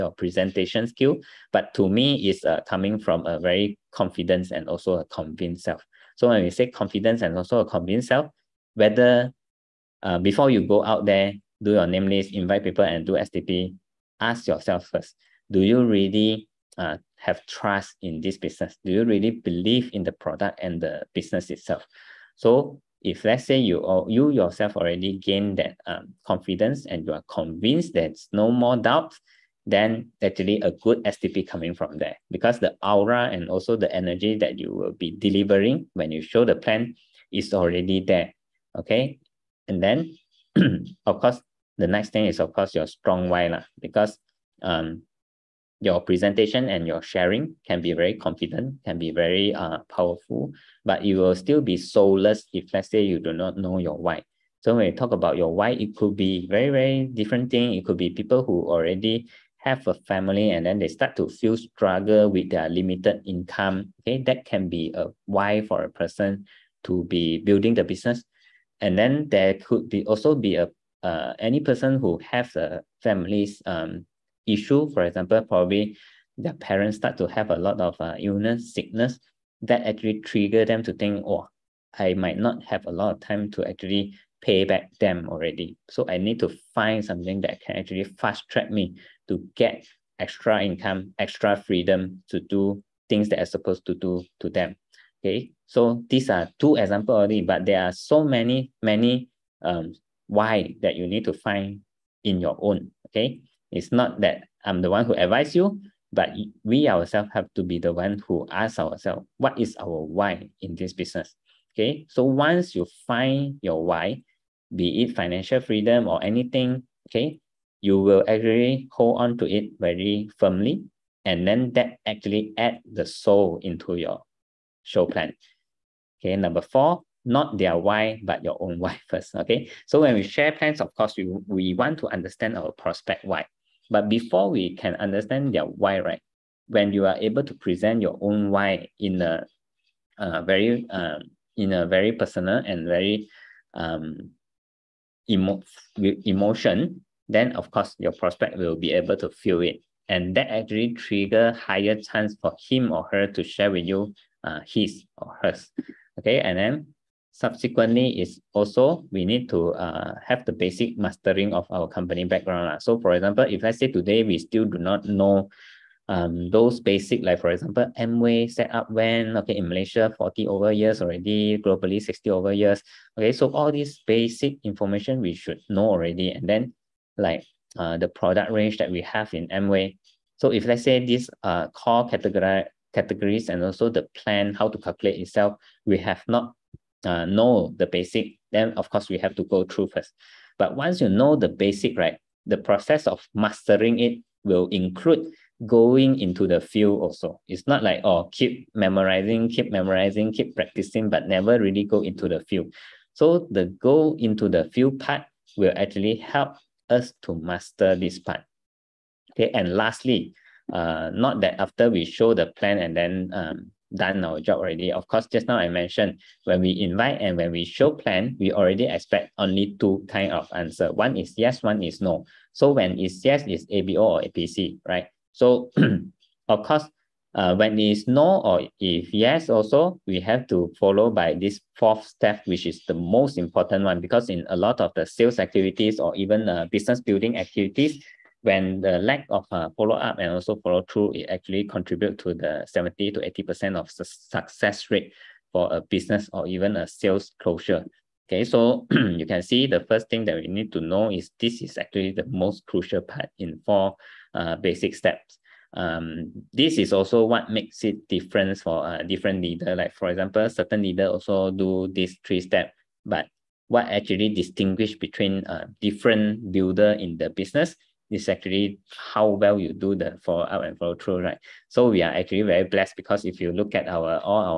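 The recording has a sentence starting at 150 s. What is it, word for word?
And that actually trigger higher chance for him or her to share with you uh, his or hers.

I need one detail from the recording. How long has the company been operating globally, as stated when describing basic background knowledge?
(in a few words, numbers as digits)
60 over years.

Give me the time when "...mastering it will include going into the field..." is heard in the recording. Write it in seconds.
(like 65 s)
193 s.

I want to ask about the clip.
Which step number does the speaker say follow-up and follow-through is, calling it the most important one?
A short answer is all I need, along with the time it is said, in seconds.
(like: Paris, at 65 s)
fourth, at 231 s.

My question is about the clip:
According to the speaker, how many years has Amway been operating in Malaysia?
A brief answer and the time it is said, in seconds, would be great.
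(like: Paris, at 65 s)
40 over years, at 170 s.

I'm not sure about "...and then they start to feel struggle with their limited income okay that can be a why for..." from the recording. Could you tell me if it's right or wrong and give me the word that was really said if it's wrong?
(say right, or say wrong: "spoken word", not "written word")
right.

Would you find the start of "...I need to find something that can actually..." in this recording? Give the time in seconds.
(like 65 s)
86 s.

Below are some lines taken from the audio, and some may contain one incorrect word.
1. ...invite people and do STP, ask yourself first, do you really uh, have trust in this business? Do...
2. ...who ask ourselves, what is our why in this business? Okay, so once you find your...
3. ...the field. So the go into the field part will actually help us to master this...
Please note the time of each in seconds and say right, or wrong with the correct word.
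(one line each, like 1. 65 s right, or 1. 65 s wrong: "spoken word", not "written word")
1. 12 s right
2. 108 s right
3. 202 s right.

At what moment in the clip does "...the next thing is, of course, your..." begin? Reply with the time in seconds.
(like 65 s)
41 s.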